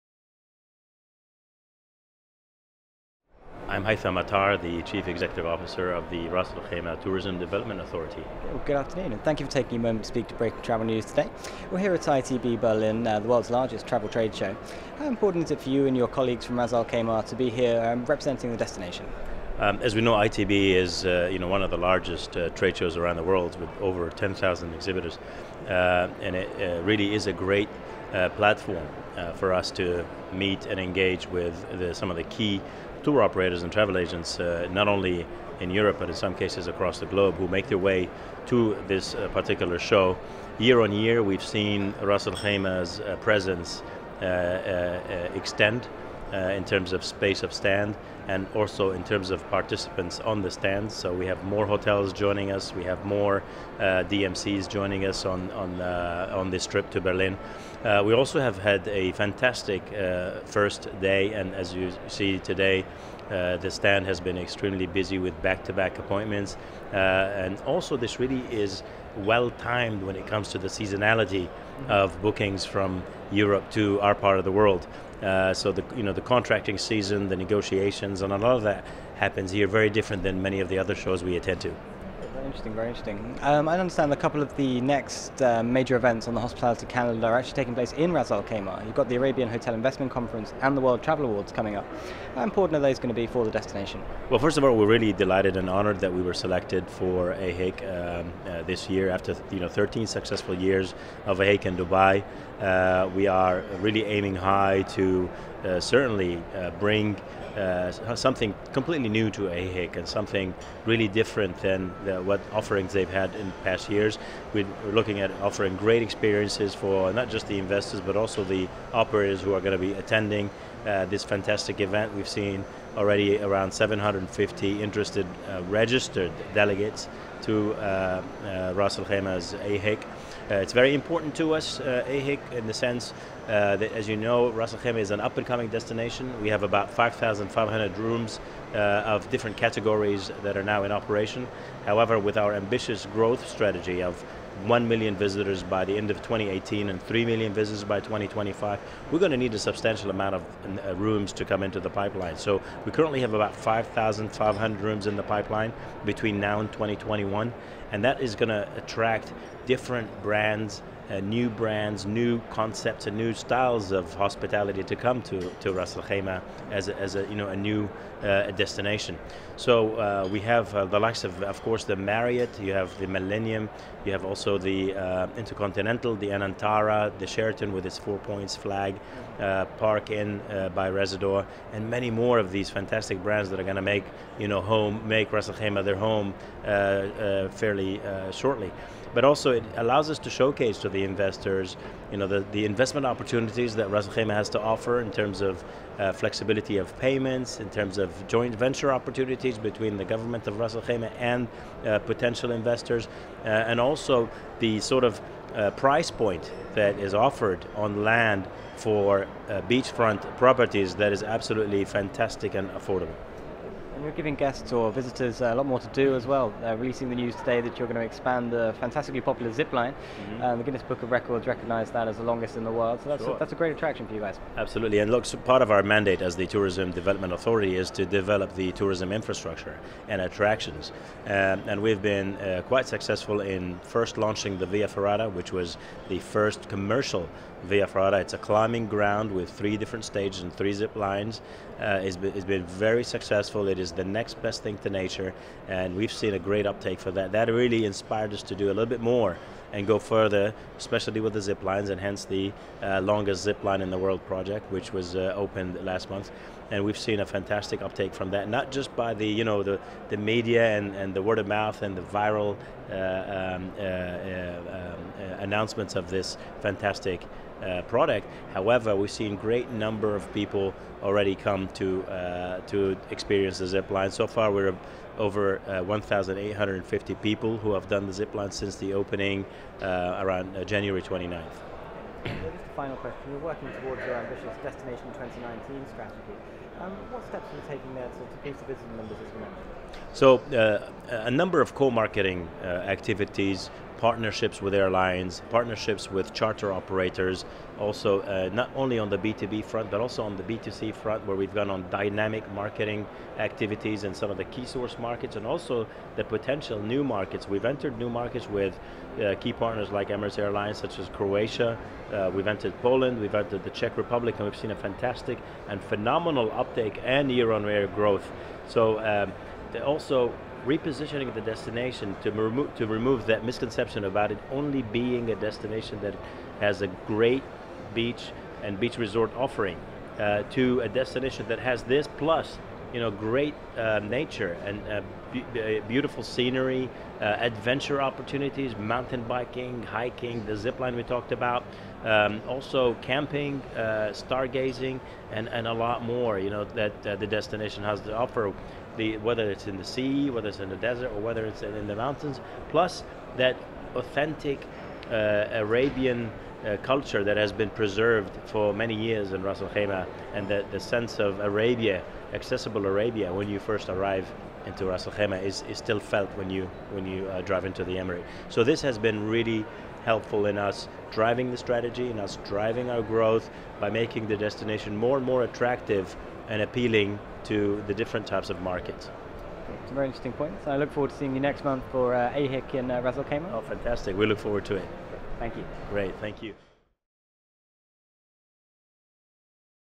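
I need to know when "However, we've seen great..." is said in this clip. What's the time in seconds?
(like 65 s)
268 s.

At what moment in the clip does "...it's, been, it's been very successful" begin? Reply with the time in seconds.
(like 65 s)
242 s.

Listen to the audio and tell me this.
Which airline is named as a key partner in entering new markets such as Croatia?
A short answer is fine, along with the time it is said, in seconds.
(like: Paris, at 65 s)
Emirates Airlines, at 310 s.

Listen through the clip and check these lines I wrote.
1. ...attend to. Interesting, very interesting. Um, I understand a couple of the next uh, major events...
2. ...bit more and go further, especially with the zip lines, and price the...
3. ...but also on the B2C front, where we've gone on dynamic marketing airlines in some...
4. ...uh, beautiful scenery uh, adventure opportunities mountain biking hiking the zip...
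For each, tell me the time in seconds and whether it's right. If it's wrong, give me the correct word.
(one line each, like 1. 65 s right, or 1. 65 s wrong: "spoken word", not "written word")
1. 81 s right
2. 248 s wrong: "hence", not "price"
3. 299 s wrong: "activities", not "airlines"
4. 335 s right.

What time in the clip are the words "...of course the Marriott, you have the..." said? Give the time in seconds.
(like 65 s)
171 s.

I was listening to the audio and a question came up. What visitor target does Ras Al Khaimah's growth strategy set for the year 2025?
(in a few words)
3 million visitors.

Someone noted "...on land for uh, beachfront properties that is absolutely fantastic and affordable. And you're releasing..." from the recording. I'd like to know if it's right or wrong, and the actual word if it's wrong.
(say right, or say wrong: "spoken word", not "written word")
wrong: "giving", not "releasing".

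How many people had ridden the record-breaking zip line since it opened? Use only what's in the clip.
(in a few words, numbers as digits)
1,850.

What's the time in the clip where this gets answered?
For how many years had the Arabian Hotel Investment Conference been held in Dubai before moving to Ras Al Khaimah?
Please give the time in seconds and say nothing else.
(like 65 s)
99 s.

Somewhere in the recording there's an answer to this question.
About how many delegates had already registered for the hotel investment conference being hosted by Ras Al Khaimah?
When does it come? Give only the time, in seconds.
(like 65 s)
123 s.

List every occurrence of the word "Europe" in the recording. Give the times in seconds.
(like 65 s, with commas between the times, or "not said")
35 s, 73 s.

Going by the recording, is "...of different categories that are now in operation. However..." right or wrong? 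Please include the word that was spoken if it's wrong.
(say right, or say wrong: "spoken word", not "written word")
right.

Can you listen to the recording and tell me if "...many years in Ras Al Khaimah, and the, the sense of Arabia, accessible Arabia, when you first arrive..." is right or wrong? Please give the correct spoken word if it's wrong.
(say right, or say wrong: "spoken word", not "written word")
right.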